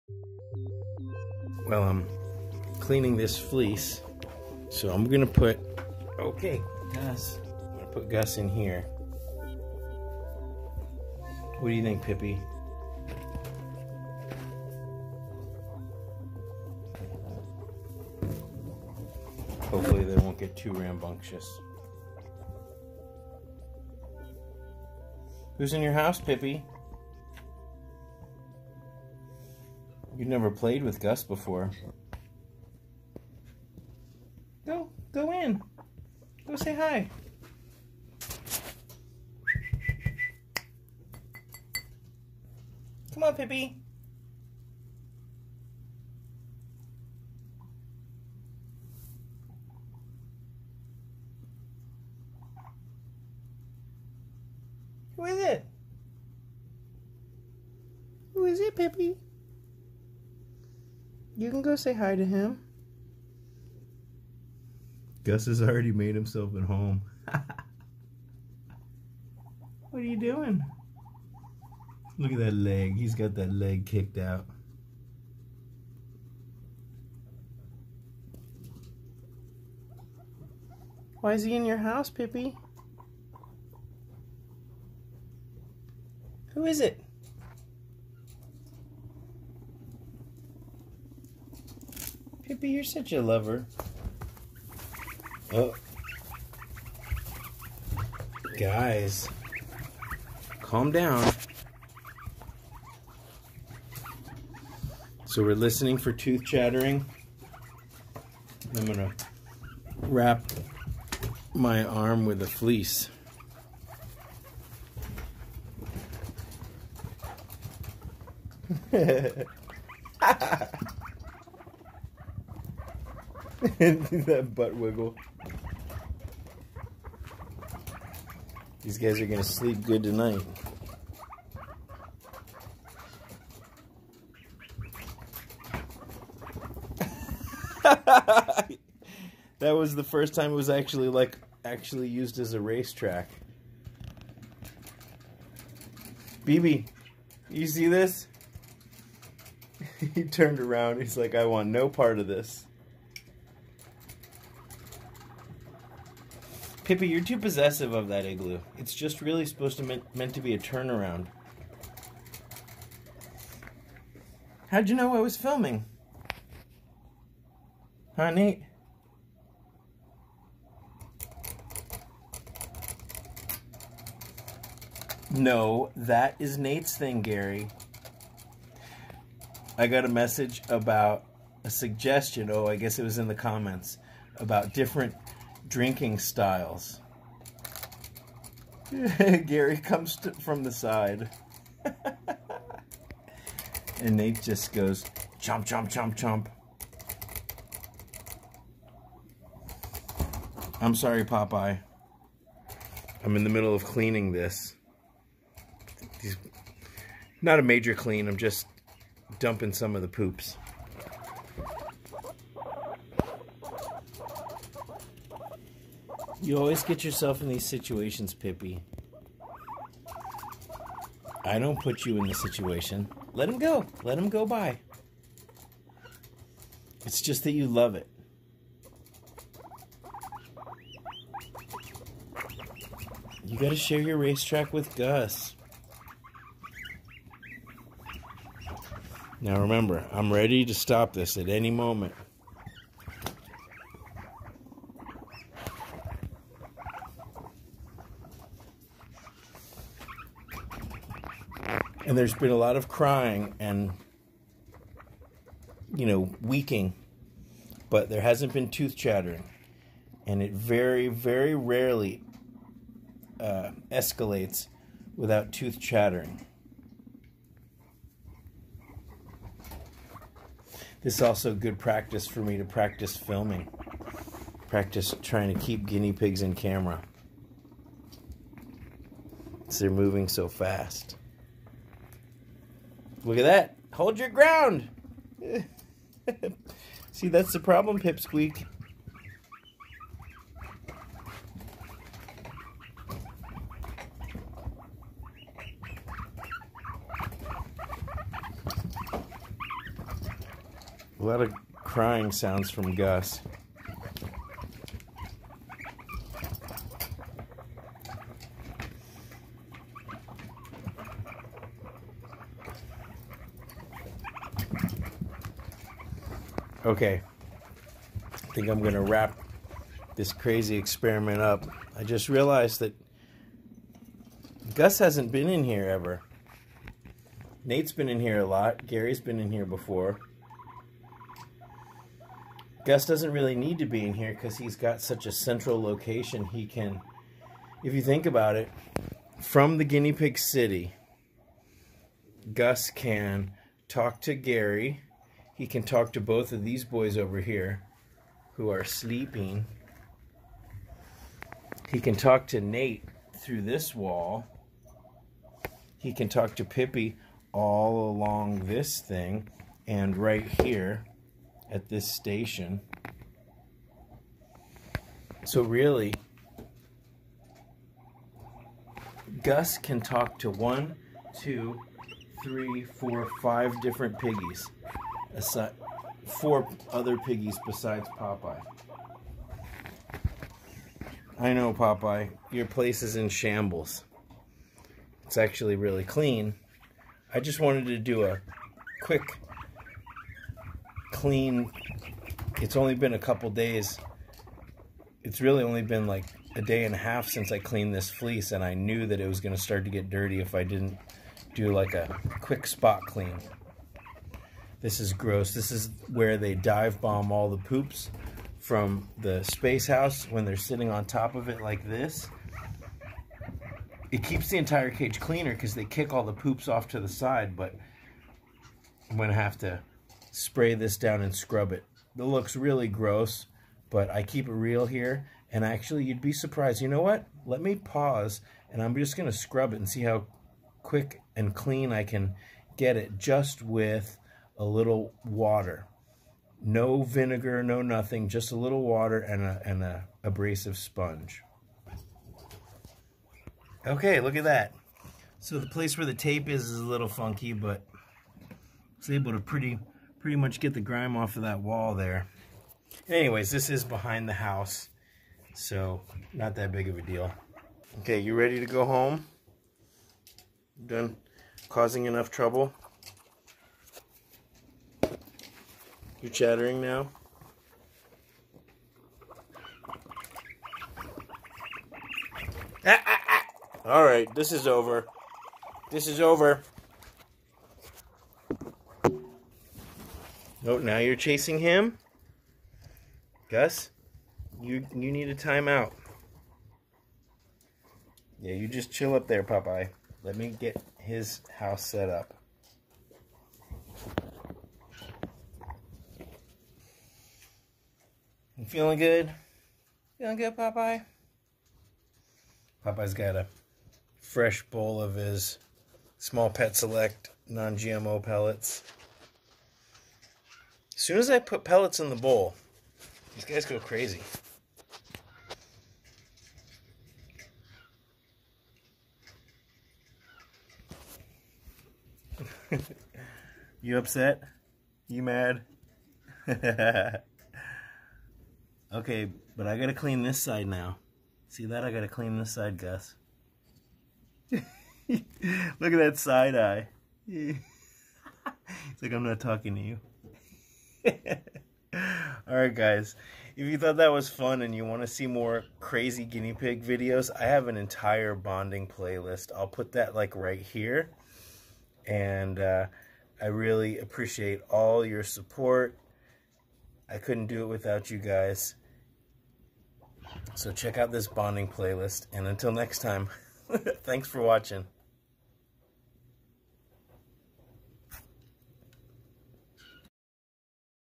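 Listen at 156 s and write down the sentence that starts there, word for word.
Kippy, you're too possessive of that igloo.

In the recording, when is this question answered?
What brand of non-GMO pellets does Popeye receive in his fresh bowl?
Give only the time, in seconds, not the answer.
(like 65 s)
506 s.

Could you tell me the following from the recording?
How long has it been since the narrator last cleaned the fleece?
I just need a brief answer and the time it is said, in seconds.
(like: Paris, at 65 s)
A day and a half, at 396 s.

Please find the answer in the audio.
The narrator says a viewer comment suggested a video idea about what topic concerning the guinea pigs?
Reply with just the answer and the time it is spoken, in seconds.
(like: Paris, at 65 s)
Different drinking styles, at 184 s.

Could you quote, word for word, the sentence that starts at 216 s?
You always get yourself in these situations, Pippi.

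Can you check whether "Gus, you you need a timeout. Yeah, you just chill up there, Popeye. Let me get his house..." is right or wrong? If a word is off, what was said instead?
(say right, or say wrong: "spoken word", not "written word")
right.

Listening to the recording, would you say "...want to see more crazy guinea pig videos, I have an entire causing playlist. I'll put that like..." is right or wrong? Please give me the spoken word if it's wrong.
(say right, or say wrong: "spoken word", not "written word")
wrong: "bonding", not "causing".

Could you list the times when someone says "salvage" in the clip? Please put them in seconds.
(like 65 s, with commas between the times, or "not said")
not said.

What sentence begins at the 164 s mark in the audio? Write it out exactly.
How'd you know I was filming?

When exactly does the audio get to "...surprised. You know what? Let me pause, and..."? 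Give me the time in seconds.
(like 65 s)
426 s.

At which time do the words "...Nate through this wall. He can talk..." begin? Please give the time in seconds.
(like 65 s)
352 s.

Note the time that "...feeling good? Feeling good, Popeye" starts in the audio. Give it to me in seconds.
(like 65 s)
498 s.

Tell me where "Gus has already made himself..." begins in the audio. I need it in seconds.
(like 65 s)
65 s.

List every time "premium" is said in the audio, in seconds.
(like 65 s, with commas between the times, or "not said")
not said.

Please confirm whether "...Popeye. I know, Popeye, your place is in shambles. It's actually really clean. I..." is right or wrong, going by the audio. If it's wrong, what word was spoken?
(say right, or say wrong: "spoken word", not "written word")
right.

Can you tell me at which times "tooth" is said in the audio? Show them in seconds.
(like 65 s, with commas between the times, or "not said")
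106 s, 258 s, 265 s.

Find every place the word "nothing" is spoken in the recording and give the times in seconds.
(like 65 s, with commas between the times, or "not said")
437 s.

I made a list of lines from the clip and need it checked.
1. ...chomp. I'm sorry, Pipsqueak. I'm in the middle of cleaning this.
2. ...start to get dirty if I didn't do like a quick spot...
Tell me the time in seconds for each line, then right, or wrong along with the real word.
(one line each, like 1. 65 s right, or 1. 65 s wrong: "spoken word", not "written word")
1. 196 s wrong: "Popeye", not "Pipsqueak"
2. 399 s right.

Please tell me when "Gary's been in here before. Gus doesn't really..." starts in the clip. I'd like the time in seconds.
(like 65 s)
328 s.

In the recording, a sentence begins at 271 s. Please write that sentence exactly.
This is also good practice for me to practice filming, practice trying to keep guinea pigs in camera.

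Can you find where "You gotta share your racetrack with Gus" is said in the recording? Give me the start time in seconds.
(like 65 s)
233 s.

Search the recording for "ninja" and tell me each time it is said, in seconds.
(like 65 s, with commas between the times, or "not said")
not said.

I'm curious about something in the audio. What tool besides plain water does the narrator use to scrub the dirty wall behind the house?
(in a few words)
Abrasive sponge.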